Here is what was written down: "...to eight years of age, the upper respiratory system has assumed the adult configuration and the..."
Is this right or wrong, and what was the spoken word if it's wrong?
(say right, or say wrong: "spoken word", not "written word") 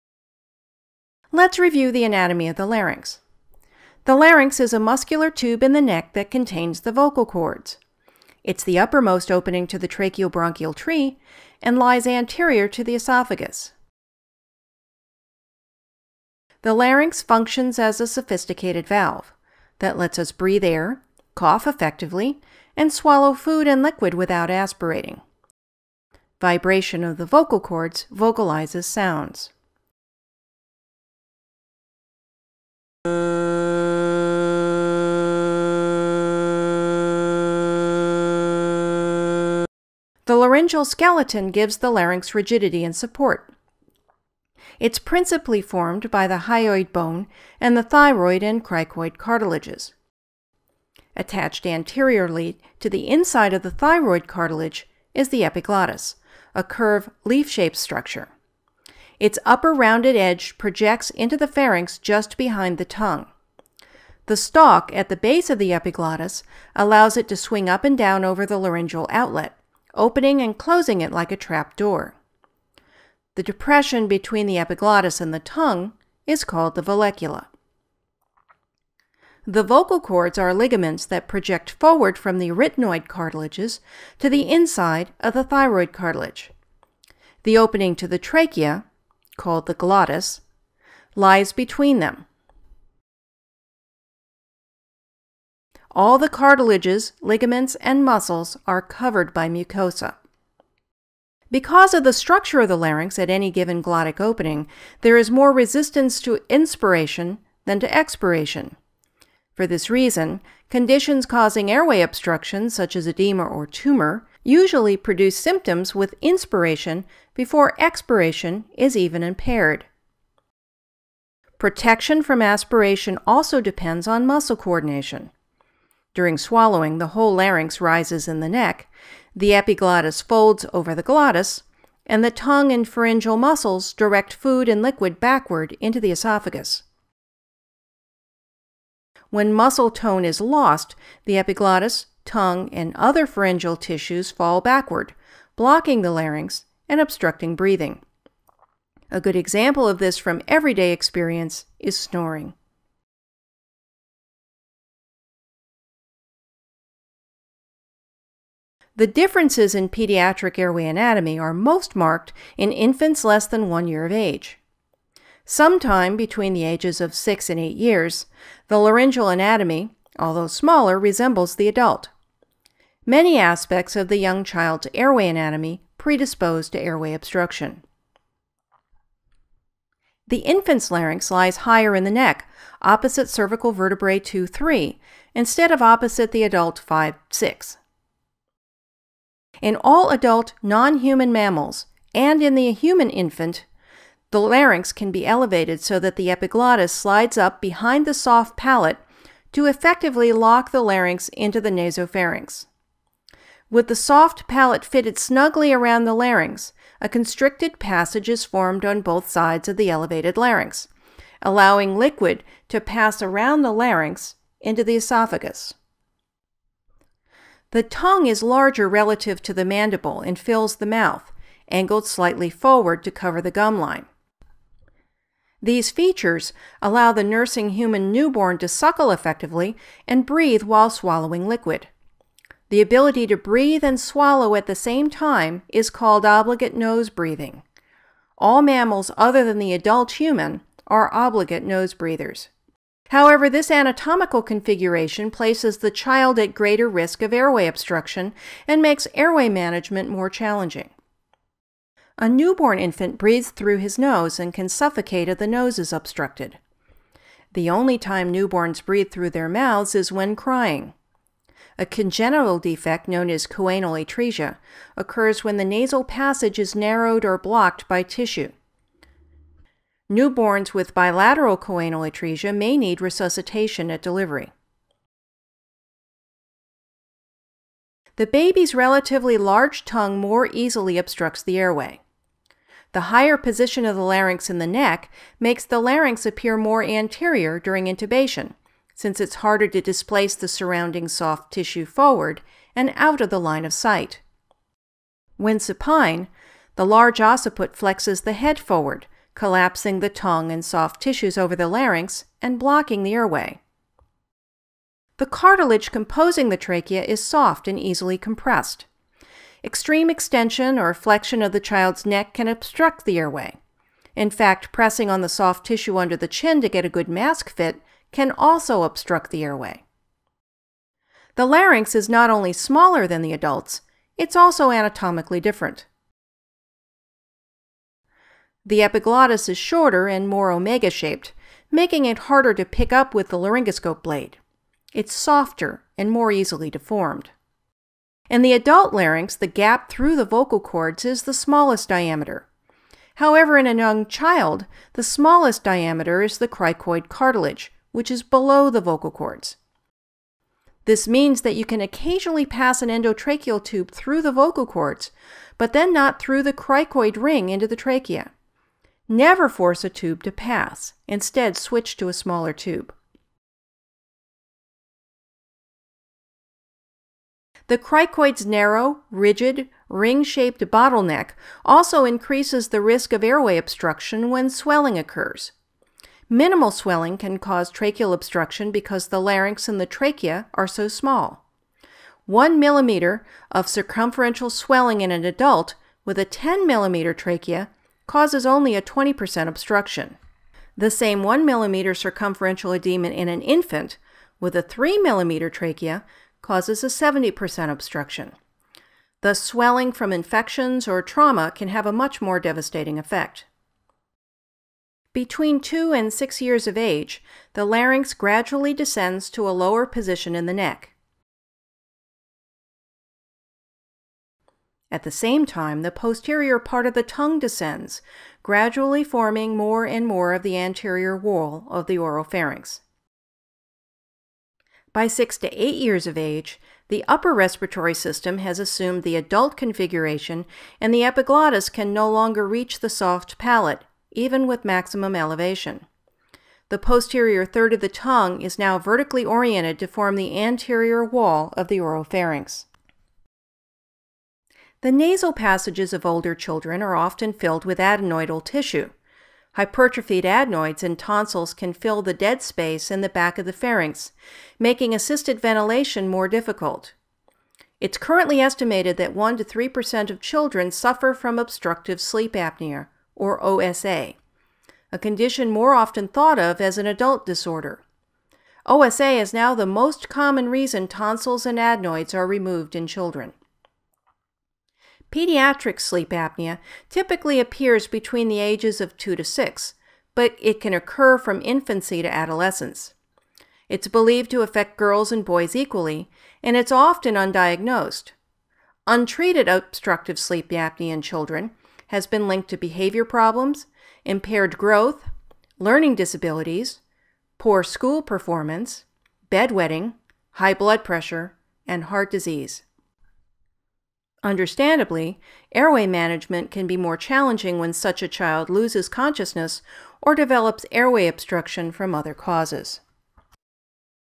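right.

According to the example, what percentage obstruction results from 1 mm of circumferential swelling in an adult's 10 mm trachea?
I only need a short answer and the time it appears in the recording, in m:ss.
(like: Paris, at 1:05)
20%, at 6:28.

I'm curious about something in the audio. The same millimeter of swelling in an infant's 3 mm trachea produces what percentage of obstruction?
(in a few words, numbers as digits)
70%.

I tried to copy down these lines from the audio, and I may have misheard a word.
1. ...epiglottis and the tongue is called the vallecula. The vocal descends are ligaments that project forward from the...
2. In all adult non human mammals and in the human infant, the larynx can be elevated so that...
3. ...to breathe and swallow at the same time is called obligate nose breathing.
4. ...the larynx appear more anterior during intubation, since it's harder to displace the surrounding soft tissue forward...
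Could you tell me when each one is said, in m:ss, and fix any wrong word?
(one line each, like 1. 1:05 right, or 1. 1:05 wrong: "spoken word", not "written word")
1. 1:14 wrong: "cords", not "descends"
2. 3:09 right
3. 3:53 right
4. 4:45 right.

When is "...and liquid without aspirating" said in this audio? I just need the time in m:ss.
0:23.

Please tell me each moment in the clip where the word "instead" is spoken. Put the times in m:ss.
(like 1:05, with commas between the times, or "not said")
3:05, 6:01.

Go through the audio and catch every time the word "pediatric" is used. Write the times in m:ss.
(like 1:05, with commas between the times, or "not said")
2:39, 7:55.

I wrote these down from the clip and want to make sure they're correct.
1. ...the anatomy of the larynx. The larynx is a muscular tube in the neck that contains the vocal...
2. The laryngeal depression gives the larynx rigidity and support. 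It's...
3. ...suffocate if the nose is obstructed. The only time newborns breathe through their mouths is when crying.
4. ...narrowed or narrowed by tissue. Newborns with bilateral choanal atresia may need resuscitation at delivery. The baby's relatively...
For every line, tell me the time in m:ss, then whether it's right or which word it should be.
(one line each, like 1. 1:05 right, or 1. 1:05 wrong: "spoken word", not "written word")
1. 0:01 right
2. 0:40 wrong: "skeleton", not "depression"
3. 4:14 right
4. 4:26 wrong: "blocked", not "narrowed".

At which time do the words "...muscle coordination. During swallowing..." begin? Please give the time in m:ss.
2:04.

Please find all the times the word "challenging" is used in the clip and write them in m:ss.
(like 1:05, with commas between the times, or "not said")
4:10, 8:26.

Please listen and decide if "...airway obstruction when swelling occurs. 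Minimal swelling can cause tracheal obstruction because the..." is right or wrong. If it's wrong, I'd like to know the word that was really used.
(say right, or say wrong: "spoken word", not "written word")
right.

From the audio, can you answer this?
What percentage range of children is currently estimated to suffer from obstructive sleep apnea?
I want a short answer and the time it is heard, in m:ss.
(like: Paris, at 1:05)
1 to 3%, at 7:39.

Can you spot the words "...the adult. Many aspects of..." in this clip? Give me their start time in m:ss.
2:51.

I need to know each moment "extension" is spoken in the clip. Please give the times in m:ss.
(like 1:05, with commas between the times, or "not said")
5:10.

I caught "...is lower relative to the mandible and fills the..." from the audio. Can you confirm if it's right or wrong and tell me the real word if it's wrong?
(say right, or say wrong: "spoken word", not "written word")
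wrong: "larger", not "lower".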